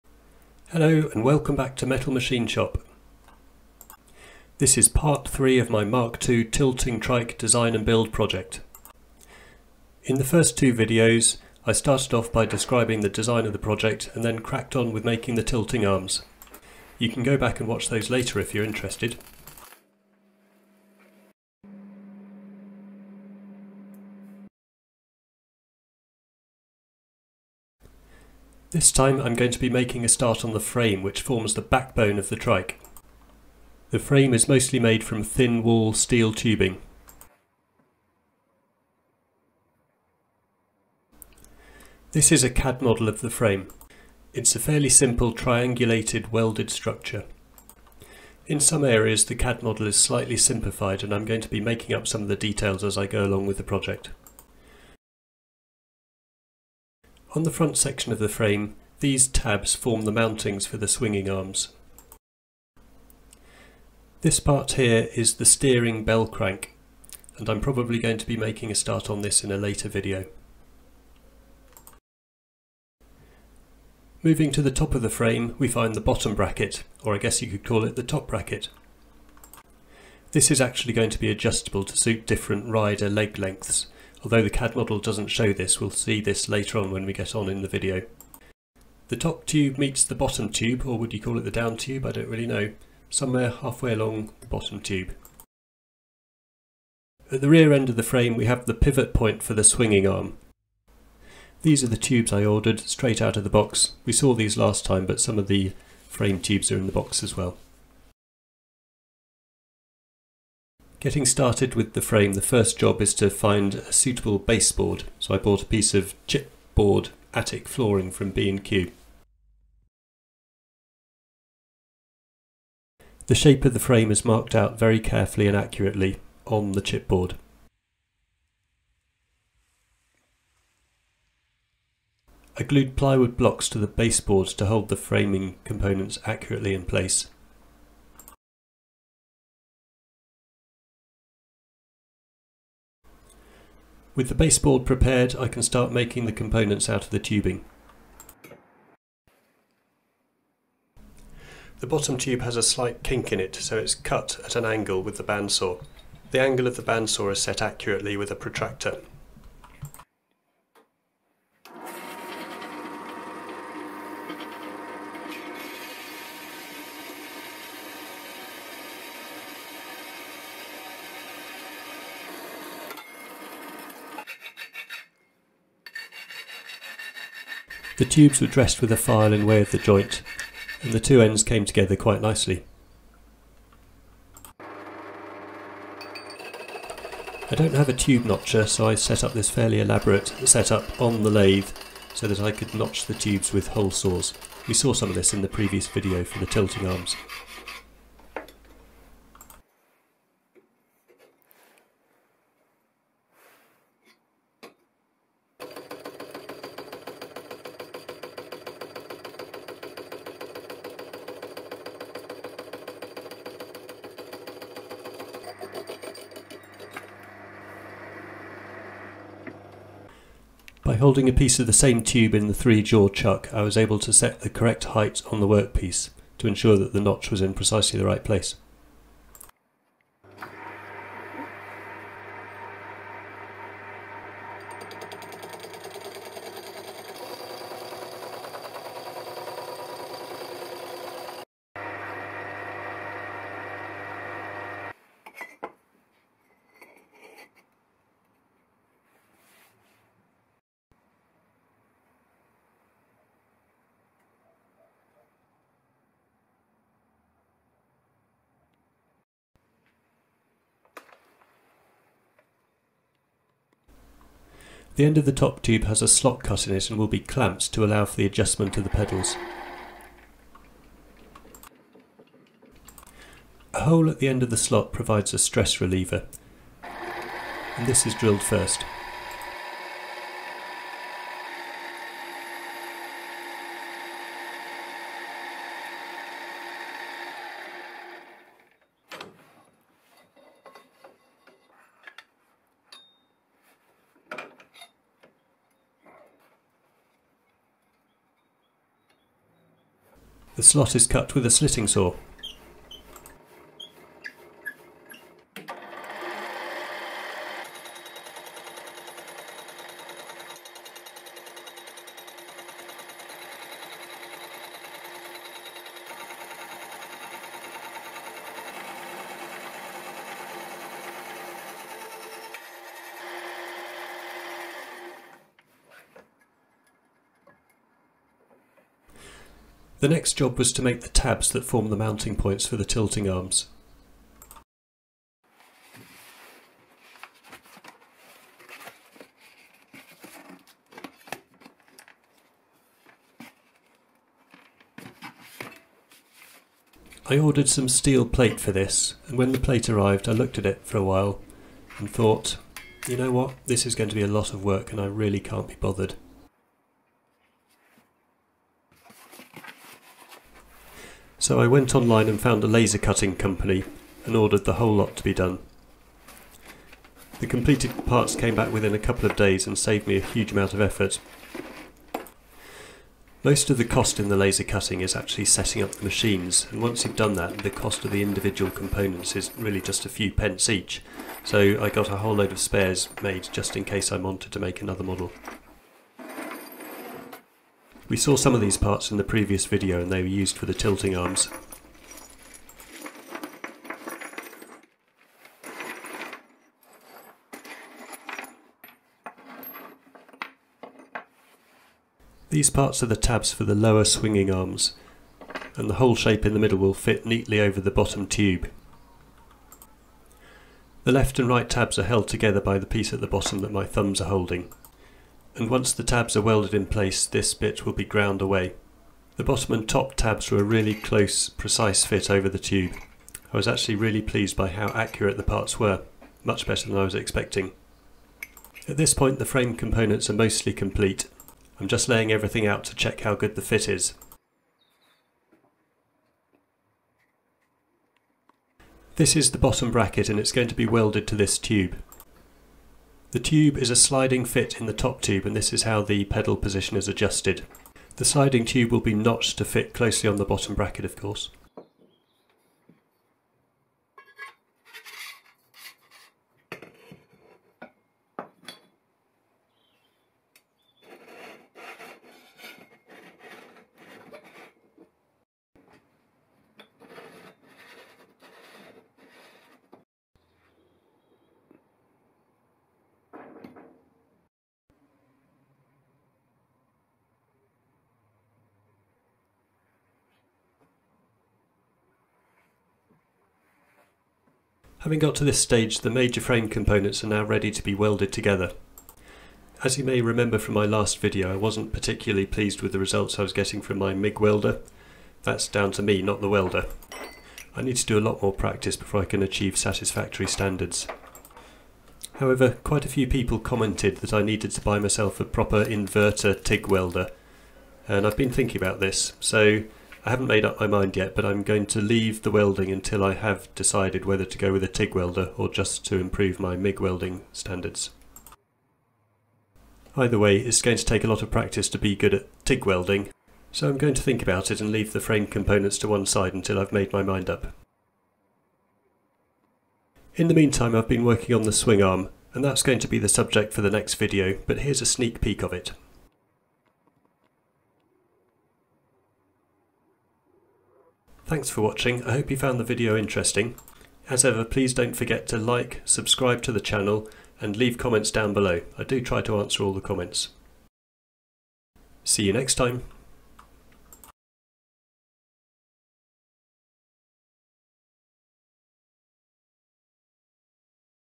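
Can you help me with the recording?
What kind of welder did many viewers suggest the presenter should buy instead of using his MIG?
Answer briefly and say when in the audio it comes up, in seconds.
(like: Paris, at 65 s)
Inverter TIG welder, at 505 s.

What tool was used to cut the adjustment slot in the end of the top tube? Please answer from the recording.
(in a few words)
Slitting saw.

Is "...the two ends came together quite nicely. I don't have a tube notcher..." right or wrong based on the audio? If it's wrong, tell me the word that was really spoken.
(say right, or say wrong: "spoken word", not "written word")
right.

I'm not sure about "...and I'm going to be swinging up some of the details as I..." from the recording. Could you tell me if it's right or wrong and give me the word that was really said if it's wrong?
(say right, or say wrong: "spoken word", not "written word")
wrong: "making", not "swinging".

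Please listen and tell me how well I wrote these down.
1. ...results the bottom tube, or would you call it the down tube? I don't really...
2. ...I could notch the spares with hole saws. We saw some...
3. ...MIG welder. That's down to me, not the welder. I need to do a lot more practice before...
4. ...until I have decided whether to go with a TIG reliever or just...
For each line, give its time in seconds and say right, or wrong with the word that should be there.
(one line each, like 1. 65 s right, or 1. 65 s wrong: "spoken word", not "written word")
1. 89 s wrong: "meets", not "results"
2. 192 s wrong: "tubes", not "spares"
3. 494 s right
4. 512 s wrong: "welder", not "reliever".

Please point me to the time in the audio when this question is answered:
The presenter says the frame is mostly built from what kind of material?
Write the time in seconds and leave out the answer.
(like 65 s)
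35 s.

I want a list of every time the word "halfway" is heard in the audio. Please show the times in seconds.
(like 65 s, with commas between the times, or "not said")
93 s.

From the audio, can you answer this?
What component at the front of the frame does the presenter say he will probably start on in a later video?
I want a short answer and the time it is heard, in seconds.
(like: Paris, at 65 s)
Steering bell crank, at 65 s.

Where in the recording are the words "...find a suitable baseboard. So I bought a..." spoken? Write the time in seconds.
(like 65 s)
113 s.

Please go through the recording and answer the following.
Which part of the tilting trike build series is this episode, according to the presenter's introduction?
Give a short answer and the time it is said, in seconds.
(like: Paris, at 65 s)
Part 3, at 4 s.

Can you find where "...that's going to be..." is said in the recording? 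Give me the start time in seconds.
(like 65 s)
532 s.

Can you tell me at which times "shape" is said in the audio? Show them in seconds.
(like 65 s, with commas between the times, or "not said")
123 s, 406 s.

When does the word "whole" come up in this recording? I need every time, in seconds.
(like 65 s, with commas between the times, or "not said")
364 s, 382 s, 405 s.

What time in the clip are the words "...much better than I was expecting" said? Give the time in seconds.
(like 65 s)
426 s.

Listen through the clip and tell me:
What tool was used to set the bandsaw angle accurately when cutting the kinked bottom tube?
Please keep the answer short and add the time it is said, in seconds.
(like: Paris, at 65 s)
Protractor, at 158 s.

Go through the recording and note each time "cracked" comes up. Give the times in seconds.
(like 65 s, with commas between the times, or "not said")
14 s.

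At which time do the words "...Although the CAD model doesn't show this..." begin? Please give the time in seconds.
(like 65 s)
84 s.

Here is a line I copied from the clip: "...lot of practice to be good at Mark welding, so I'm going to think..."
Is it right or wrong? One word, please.
wrong.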